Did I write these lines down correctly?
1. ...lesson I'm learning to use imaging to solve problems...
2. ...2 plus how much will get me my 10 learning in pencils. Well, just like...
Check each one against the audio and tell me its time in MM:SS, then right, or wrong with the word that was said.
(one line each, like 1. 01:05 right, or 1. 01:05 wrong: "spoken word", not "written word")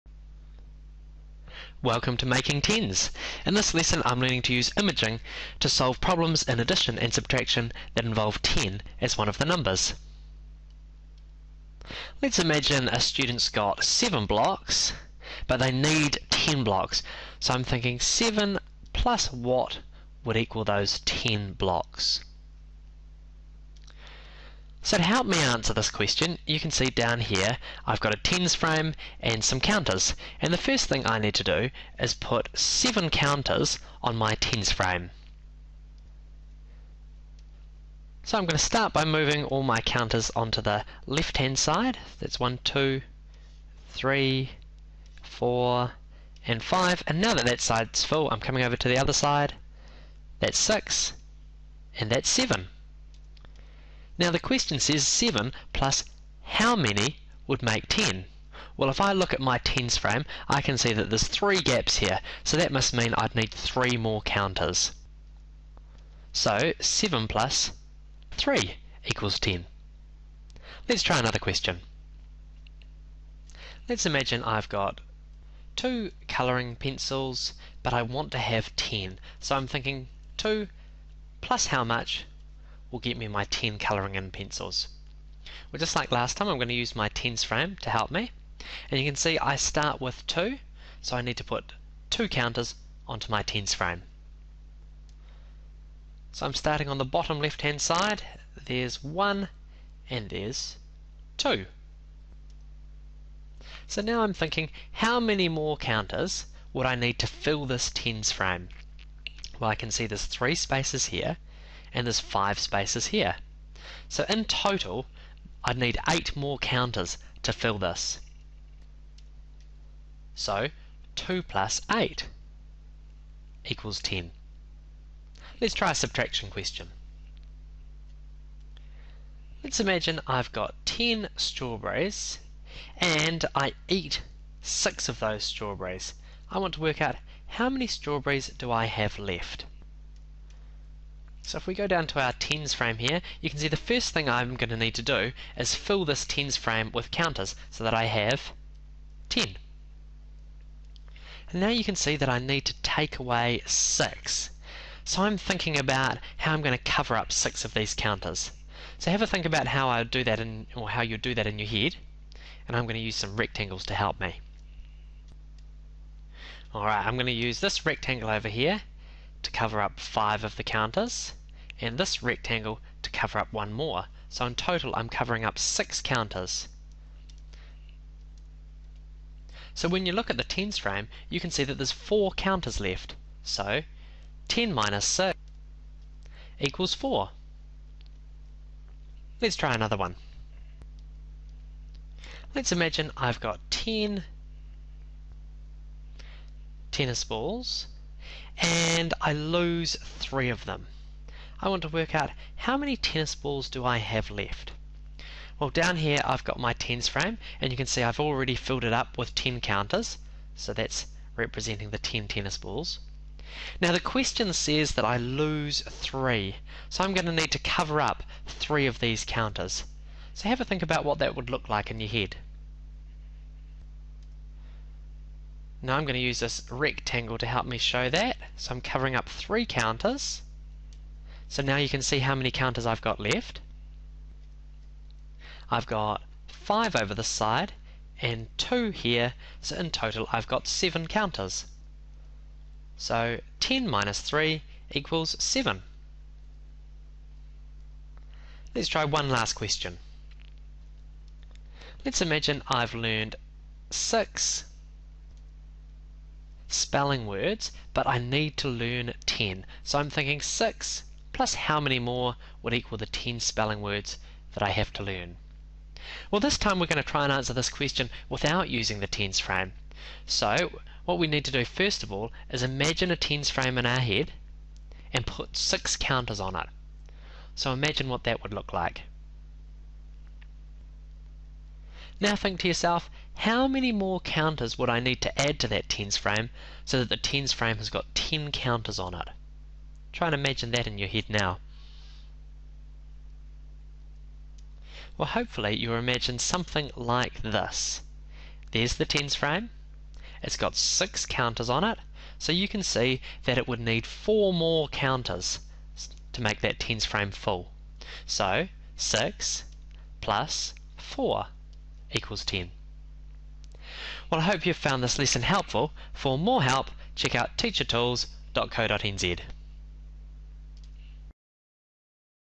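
1. 00:03 right
2. 01:20 wrong: "colouring", not "learning".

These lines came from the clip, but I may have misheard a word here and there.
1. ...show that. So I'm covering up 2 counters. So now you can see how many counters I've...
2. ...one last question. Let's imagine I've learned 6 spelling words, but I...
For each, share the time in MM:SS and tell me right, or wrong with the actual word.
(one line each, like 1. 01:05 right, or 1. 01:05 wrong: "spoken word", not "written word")
1. 03:47 wrong: "3", not "2"
2. 04:09 right.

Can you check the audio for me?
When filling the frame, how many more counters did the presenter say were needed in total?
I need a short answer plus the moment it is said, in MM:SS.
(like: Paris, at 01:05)
8, at 01:56.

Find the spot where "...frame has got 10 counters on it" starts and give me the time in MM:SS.
04:47.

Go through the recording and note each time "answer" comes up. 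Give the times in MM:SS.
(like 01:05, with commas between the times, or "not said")
00:25, 04:27.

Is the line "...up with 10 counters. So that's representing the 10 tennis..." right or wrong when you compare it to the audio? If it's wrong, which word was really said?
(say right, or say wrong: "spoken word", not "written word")
right.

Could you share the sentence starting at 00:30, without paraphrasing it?
And the first thing I need to do is put 7 counters on my tens frame.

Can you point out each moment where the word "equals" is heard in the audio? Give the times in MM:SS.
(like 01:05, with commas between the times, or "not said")
00:20, 01:09, 02:03, 03:06, 04:04, 04:22, 05:12.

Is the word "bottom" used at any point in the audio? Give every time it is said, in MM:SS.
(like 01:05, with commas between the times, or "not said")
01:37.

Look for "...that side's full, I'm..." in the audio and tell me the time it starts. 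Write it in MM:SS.
00:47.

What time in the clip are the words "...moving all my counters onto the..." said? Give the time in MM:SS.
00:39.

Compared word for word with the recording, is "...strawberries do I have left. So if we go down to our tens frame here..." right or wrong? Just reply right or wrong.
right.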